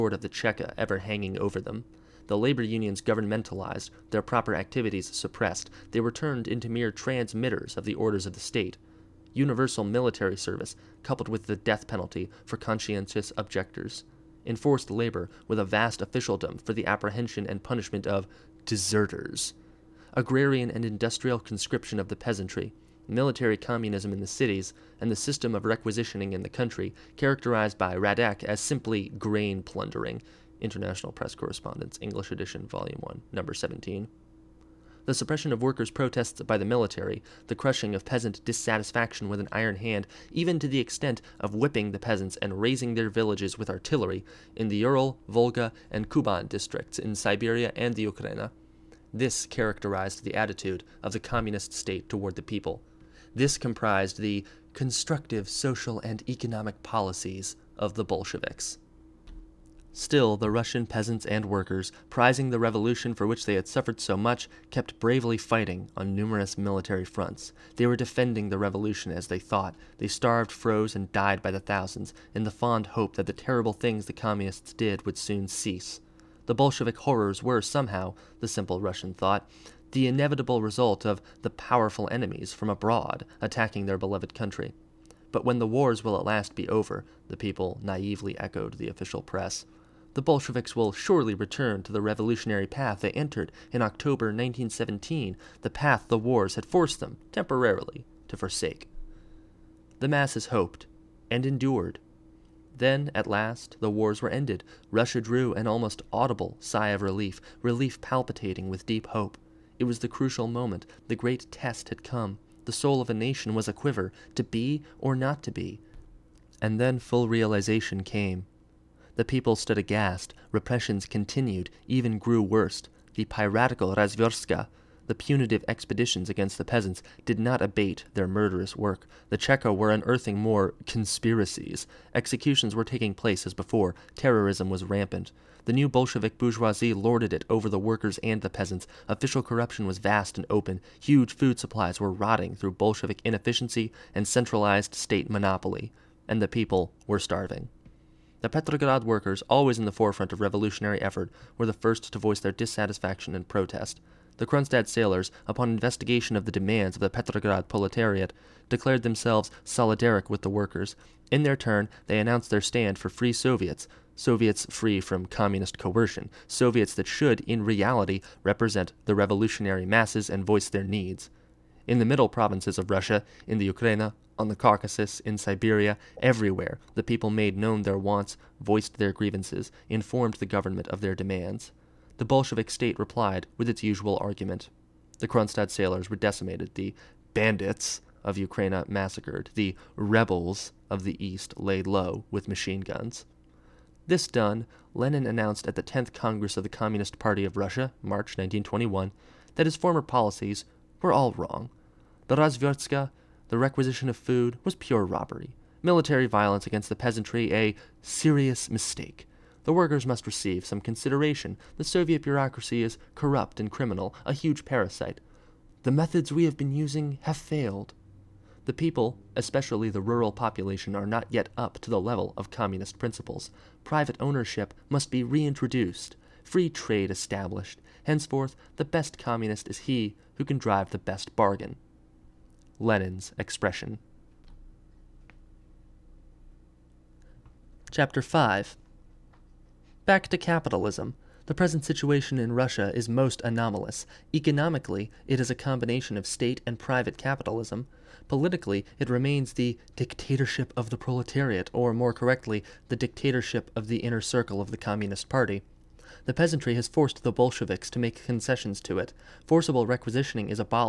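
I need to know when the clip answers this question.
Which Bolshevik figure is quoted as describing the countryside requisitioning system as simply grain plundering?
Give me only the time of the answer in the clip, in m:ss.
0:27.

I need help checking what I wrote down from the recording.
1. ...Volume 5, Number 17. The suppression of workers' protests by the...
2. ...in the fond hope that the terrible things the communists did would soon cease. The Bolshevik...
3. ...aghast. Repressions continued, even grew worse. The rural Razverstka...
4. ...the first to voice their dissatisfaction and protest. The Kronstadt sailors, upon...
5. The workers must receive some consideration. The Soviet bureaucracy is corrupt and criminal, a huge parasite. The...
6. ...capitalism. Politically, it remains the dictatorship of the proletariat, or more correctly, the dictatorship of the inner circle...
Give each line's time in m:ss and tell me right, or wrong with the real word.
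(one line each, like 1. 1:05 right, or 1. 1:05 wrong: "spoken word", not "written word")
1. 0:32 wrong: "1", not "5"
2. 1:12 right
3. 1:59 wrong: "piratical", not "rural"
4. 2:31 right
5. 3:29 right
6. 4:07 right.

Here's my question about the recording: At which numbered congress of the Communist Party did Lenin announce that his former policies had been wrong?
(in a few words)
10th Congress.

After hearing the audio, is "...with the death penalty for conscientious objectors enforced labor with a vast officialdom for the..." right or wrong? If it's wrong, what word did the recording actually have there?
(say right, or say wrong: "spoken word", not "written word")
right.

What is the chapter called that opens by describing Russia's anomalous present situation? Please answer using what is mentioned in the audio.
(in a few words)
Back to capitalism.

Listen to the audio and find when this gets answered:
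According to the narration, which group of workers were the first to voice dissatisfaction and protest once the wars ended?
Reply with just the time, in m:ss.
2:28.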